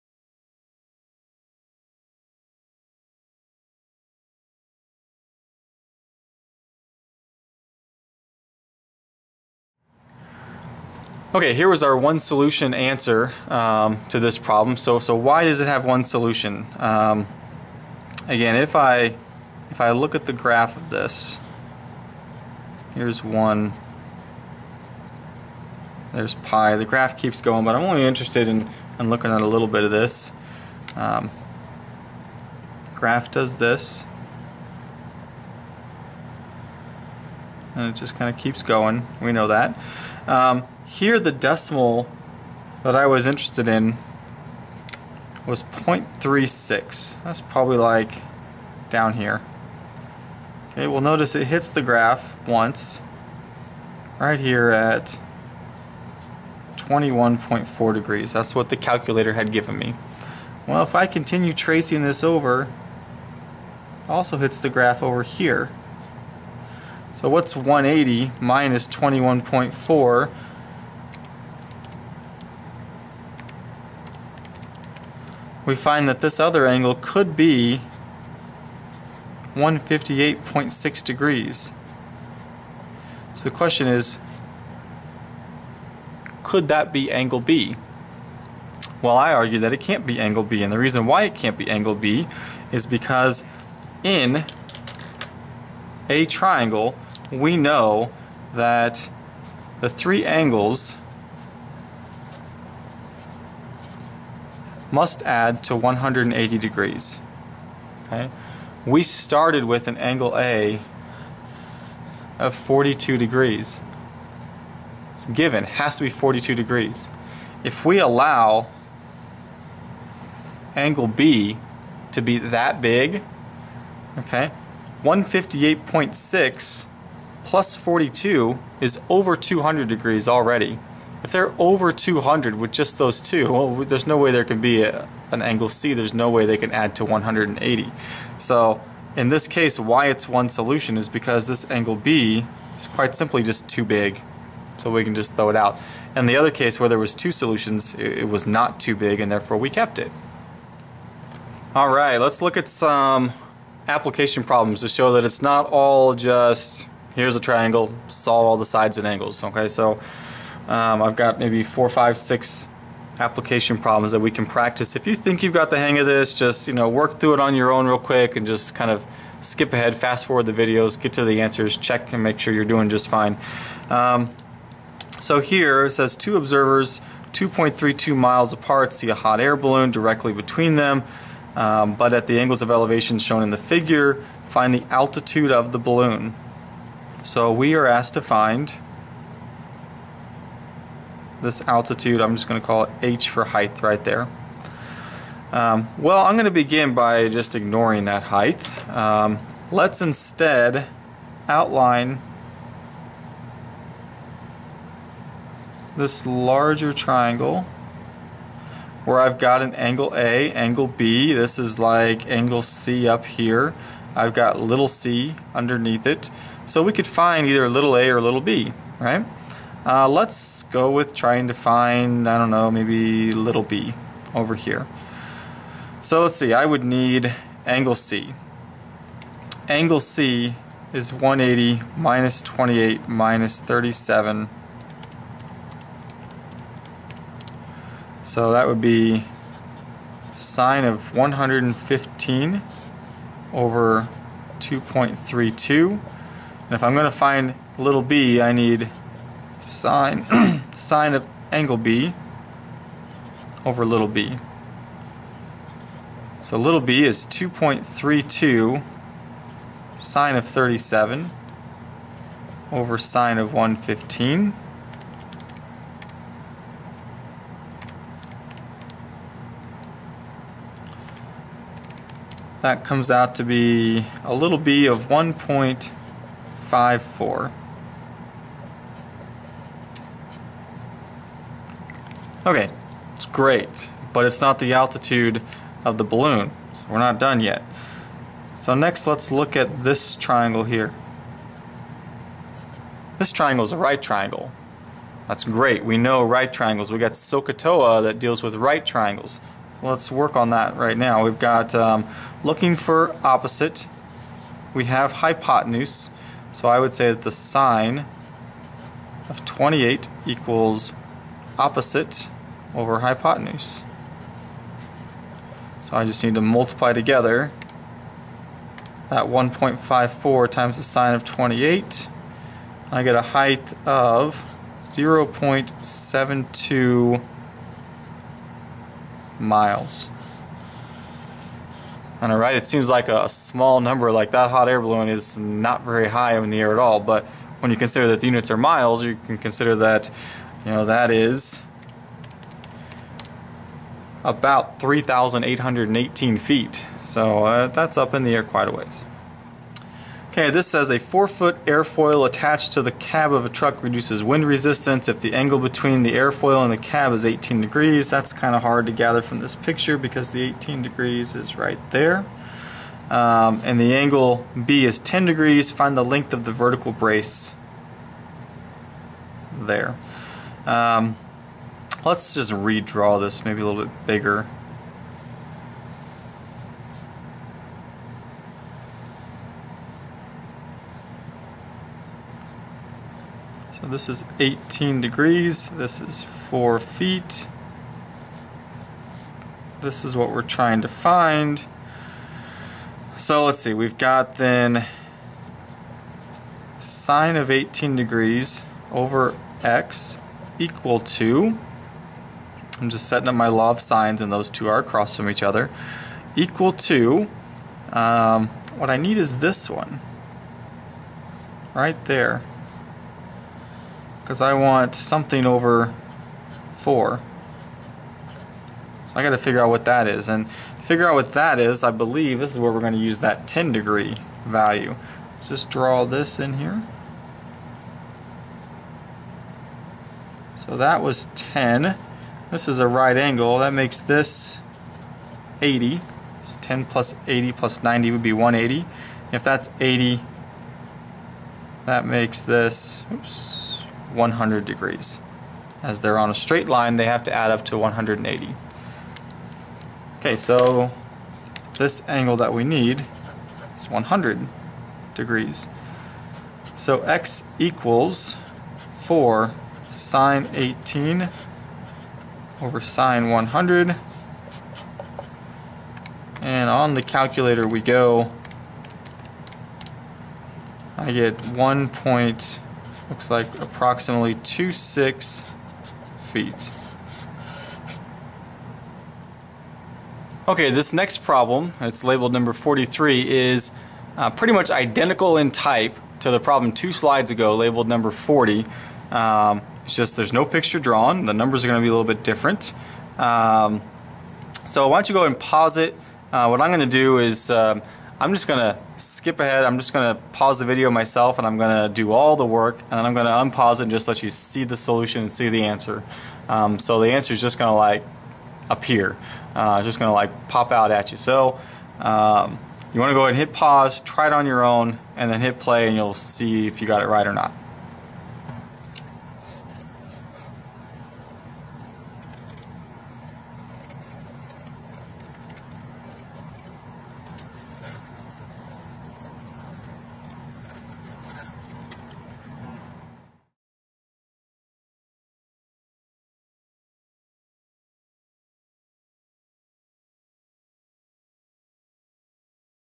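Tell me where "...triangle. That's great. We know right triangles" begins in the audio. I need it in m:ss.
4:54.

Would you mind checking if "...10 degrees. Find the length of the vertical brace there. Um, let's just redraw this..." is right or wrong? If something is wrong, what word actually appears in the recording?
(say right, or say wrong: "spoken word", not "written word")
right.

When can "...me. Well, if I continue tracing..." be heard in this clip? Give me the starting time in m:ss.
0:59.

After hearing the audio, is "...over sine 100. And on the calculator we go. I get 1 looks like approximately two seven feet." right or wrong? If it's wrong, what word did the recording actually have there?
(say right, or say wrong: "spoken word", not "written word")
wrong: "six", not "seven".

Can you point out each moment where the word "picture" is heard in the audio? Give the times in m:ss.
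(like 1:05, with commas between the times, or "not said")
5:59, 8:10.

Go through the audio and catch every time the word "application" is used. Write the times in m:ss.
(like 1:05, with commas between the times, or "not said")
2:33, 2:43.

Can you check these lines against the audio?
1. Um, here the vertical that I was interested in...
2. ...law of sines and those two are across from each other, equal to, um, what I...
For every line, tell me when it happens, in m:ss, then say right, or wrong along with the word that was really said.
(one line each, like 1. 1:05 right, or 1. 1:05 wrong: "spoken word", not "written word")
1. 0:40 wrong: "decimal", not "vertical"
2. 6:43 right.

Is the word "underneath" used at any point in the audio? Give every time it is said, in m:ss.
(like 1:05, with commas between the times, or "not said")
3:35.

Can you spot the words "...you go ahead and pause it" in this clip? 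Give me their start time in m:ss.
8:15.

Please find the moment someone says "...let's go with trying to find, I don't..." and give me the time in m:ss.
3:40.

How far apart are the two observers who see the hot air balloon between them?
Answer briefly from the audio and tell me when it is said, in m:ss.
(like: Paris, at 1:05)
2.32 miles, at 2:57.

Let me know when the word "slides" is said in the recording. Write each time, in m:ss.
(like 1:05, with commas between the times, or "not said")
8:06.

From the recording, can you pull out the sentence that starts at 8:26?
Um, so the answer is just gonna like appear.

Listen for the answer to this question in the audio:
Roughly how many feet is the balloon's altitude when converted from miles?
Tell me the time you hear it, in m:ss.
5:44.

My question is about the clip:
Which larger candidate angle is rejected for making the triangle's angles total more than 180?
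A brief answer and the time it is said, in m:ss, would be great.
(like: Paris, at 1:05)
158.6 degrees, at 1:19.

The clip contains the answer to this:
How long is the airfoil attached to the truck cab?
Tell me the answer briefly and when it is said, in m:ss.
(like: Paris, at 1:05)
4 feet, at 5:50.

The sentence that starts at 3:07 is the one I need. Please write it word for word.
So we are asked to find this altitude.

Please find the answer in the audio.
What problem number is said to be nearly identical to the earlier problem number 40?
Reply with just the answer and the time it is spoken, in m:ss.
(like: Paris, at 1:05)
43, at 8:02.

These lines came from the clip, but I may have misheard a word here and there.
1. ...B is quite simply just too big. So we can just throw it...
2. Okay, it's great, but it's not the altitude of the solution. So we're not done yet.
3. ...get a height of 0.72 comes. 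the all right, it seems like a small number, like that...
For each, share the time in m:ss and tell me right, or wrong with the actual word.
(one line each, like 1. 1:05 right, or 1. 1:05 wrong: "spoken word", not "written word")
1. 2:21 right
2. 4:42 wrong: "balloon", not "solution"
3. 5:23 wrong: "miles", not "comes".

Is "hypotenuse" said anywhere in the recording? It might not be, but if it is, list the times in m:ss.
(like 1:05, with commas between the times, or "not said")
5:05, 5:12.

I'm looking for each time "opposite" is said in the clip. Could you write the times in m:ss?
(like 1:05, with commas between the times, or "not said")
5:03, 5:11.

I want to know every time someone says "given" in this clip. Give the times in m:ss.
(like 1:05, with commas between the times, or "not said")
0:59, 1:55.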